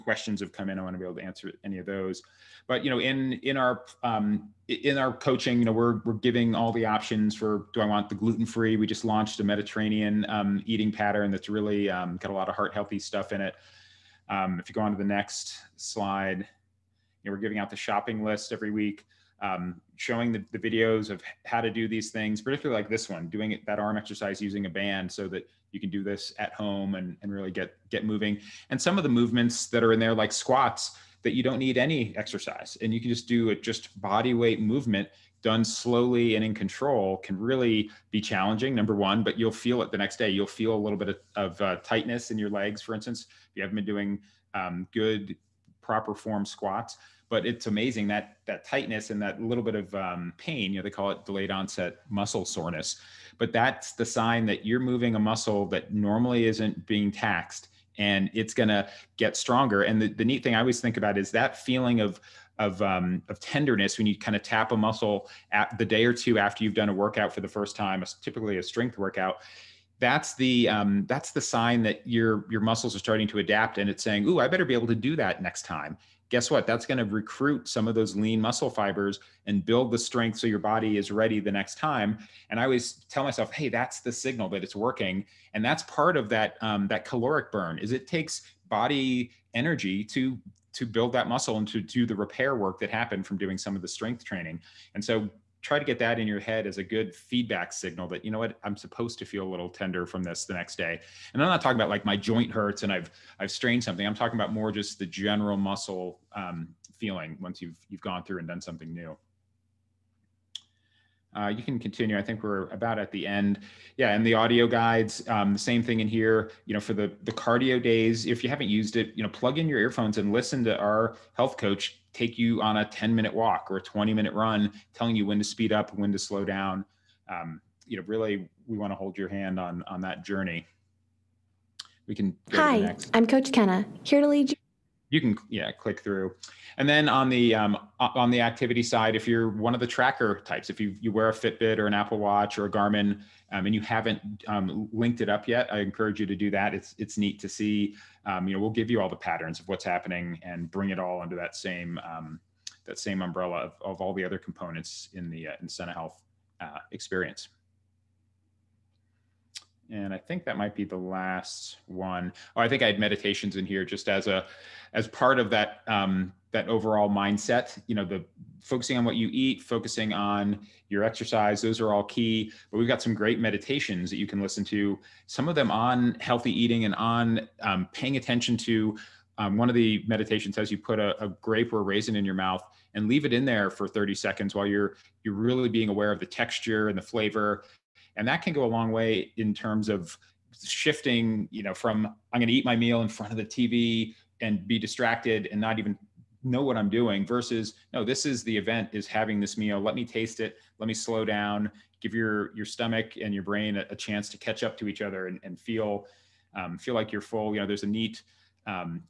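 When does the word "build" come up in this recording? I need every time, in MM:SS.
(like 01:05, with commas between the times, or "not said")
01:19, 01:30.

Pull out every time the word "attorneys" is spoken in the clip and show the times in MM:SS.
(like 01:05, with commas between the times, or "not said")
not said.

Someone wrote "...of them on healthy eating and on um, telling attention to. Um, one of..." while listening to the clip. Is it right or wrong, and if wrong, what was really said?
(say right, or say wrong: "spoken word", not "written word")
wrong: "paying", not "telling".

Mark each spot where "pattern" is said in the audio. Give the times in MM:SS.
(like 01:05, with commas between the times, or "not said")
00:10, 02:29.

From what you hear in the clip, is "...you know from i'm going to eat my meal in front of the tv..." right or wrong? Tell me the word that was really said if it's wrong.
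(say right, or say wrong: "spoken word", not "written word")
right.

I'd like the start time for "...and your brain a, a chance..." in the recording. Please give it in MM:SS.
03:23.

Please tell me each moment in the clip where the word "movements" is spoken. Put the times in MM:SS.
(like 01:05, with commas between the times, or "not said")
00:29, 00:34.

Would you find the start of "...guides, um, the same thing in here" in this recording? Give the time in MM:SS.
01:54.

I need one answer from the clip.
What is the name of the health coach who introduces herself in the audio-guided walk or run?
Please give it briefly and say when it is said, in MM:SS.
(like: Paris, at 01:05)
Coach Kenna, at 02:13.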